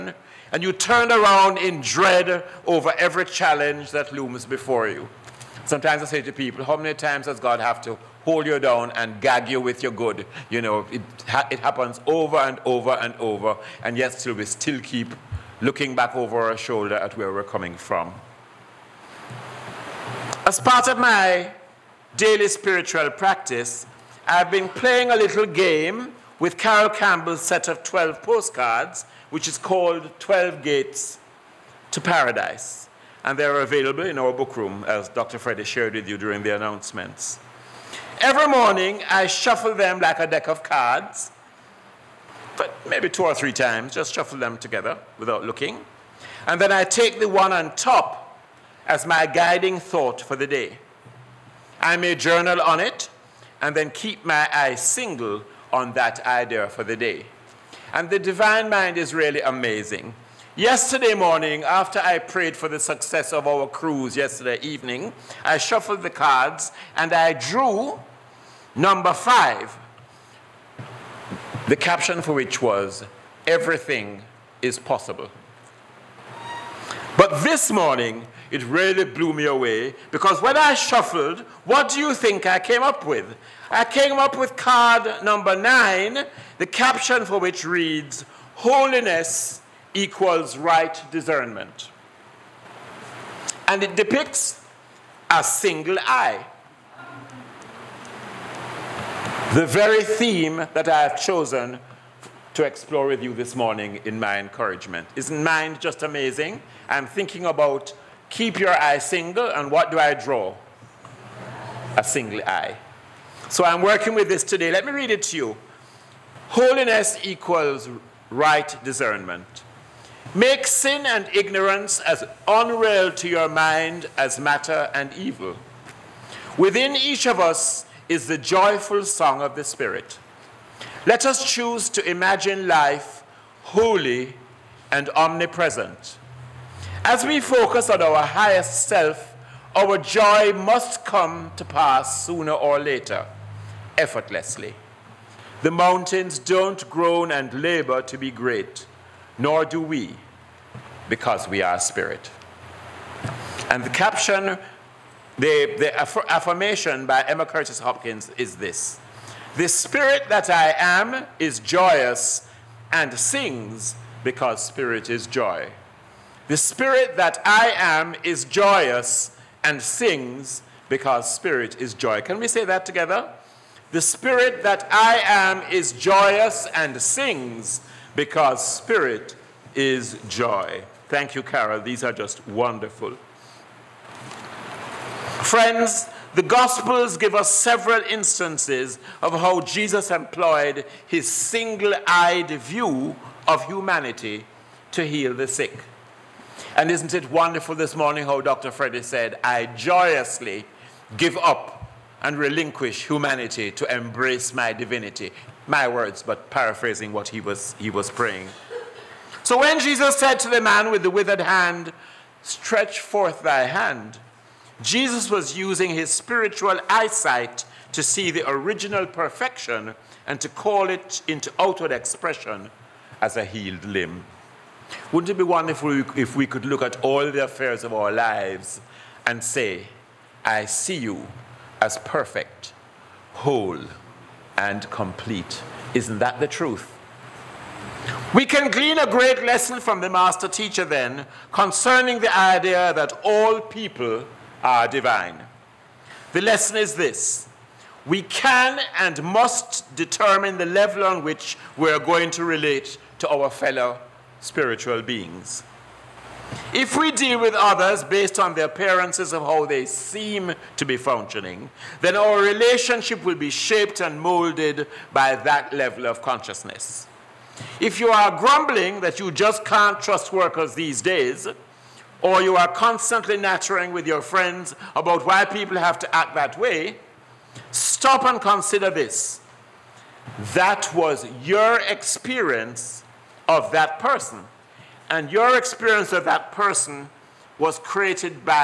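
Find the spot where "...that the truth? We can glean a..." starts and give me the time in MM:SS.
03:56.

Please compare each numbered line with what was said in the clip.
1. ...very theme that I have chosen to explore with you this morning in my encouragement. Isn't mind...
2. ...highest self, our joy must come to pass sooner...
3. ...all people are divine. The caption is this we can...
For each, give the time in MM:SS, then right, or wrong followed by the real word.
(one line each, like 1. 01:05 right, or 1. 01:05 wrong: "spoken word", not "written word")
1. 01:39 right
2. 02:18 right
3. 04:03 wrong: "lesson", not "caption".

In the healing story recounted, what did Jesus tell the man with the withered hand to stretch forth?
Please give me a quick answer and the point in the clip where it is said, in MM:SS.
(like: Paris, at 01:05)
thy hand, at 03:33.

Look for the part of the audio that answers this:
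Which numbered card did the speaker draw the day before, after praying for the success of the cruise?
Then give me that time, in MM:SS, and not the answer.
01:08.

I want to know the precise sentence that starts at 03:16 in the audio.
And isn't it wonderful this morning how Dr.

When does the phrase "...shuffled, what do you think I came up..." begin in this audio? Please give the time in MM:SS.
01:20.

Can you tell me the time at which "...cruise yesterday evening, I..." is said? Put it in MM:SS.
01:03.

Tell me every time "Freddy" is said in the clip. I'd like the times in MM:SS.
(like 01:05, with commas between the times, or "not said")
00:35, 03:18.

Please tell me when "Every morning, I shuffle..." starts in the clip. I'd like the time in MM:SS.
00:38.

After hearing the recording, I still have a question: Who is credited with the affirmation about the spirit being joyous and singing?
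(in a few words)
Emma Curtis Hopkins.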